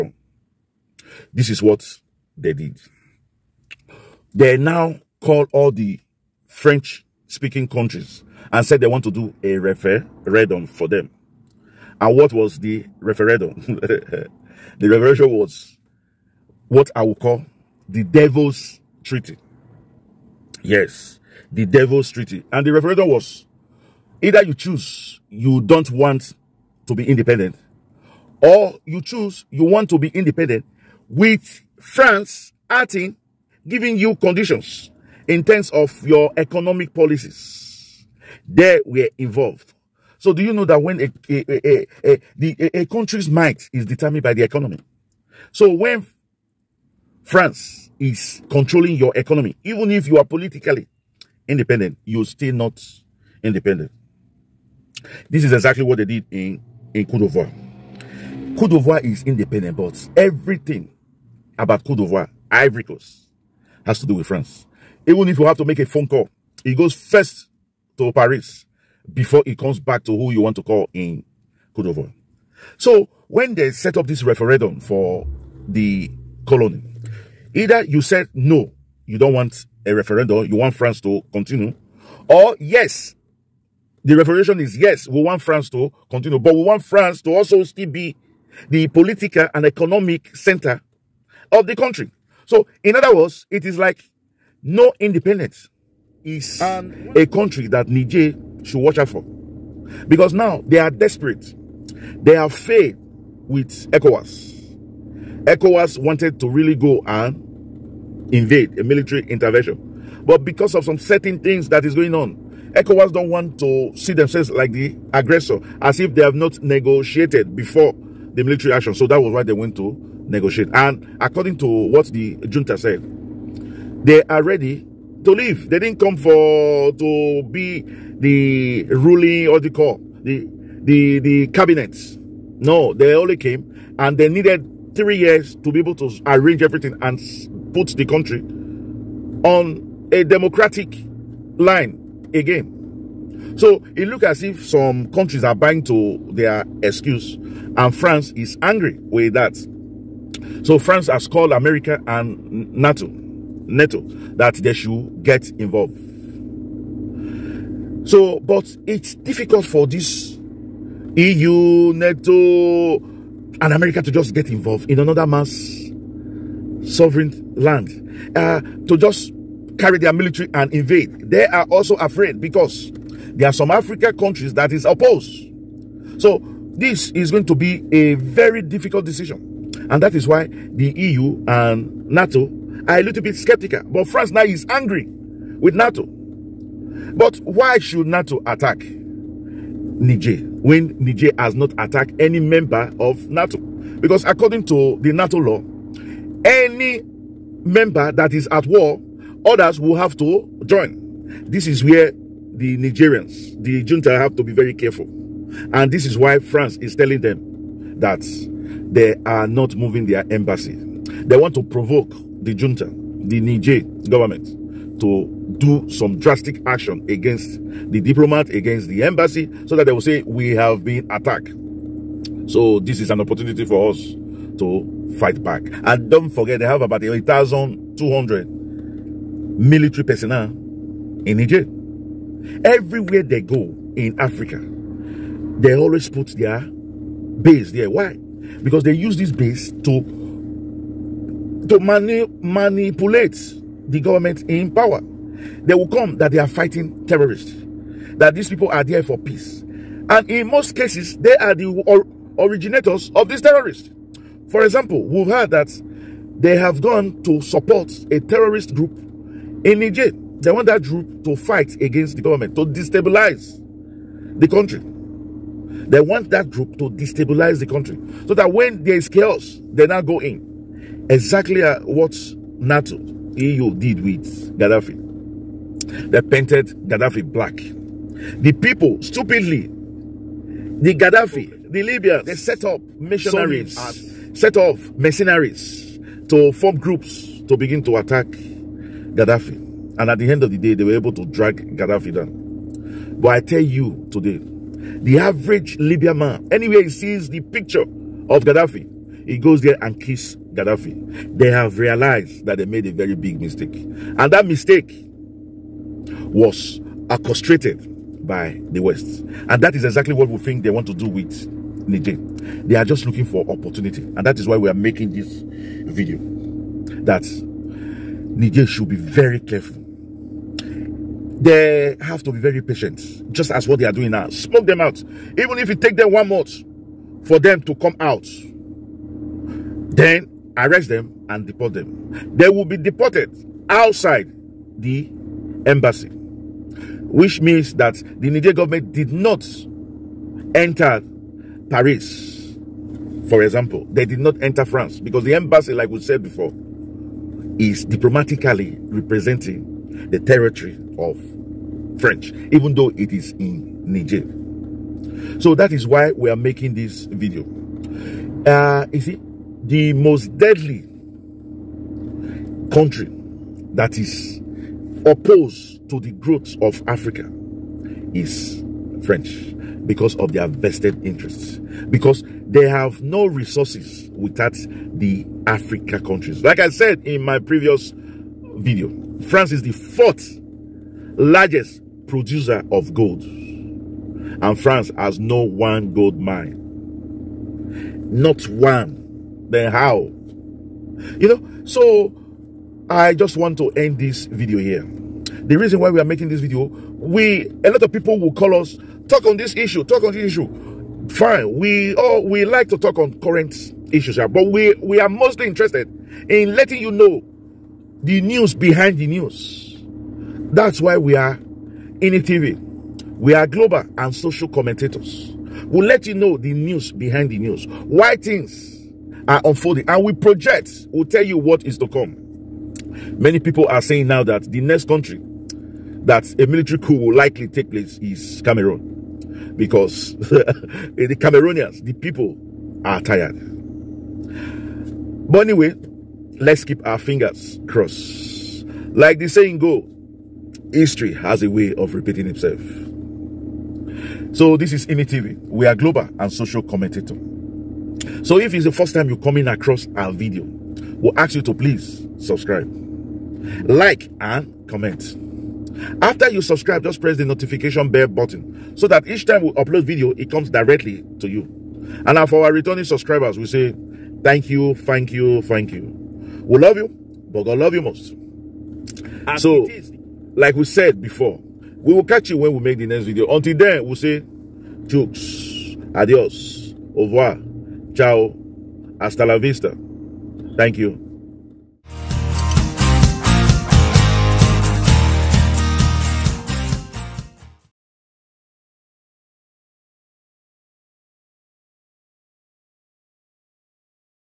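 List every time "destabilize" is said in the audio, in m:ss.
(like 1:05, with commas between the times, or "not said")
4:22, 4:26.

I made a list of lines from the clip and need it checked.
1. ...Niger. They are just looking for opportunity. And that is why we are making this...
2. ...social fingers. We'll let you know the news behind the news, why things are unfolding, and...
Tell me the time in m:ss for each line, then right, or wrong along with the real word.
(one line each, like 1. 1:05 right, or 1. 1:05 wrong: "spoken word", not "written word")
1. 5:11 right
2. 6:54 wrong: "commentators", not "fingers".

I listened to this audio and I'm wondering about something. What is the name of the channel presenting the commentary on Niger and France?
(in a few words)
IMI TV.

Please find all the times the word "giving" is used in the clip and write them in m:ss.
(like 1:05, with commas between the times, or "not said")
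0:33.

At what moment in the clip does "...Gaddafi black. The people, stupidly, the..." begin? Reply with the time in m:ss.
4:36.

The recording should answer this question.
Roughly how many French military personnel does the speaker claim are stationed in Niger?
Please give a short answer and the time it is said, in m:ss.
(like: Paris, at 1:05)
8,200, at 3:47.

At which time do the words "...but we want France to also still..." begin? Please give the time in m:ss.
1:26.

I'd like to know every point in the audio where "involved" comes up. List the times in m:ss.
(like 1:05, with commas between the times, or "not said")
0:39, 2:35, 2:44.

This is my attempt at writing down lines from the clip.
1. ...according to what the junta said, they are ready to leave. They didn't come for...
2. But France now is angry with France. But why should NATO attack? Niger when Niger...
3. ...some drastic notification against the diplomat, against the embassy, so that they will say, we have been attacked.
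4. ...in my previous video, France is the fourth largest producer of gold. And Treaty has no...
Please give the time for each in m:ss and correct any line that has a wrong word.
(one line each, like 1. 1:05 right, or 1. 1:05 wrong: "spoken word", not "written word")
1. 2:01 right
2. 3:03 wrong: "NATO", not "France"
3. 3:35 wrong: "action", not "notification"
4. 6:17 wrong: "France", not "Treaty".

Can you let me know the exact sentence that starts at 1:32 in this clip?
So, in other words, it is like no independence is a country that Niger should watch out for.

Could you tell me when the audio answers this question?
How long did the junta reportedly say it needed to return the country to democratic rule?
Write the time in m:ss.
2:14.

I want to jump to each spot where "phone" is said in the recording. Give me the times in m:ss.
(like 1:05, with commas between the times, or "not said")
1:05.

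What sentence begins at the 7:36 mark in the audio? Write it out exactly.
After you subscribe, just press the notification bell button so that each time we upload video, it comes directly to you.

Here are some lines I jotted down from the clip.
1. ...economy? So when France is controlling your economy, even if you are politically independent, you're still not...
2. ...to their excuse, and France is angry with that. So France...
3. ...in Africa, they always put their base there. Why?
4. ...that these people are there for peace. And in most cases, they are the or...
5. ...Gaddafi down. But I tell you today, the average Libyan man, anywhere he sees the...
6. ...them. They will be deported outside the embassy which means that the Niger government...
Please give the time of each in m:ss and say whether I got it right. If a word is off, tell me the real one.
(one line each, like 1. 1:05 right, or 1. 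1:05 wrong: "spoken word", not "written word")
1. 0:44 right
2. 2:25 right
3. 3:53 right
4. 4:08 right
5. 4:51 right
6. 5:31 right.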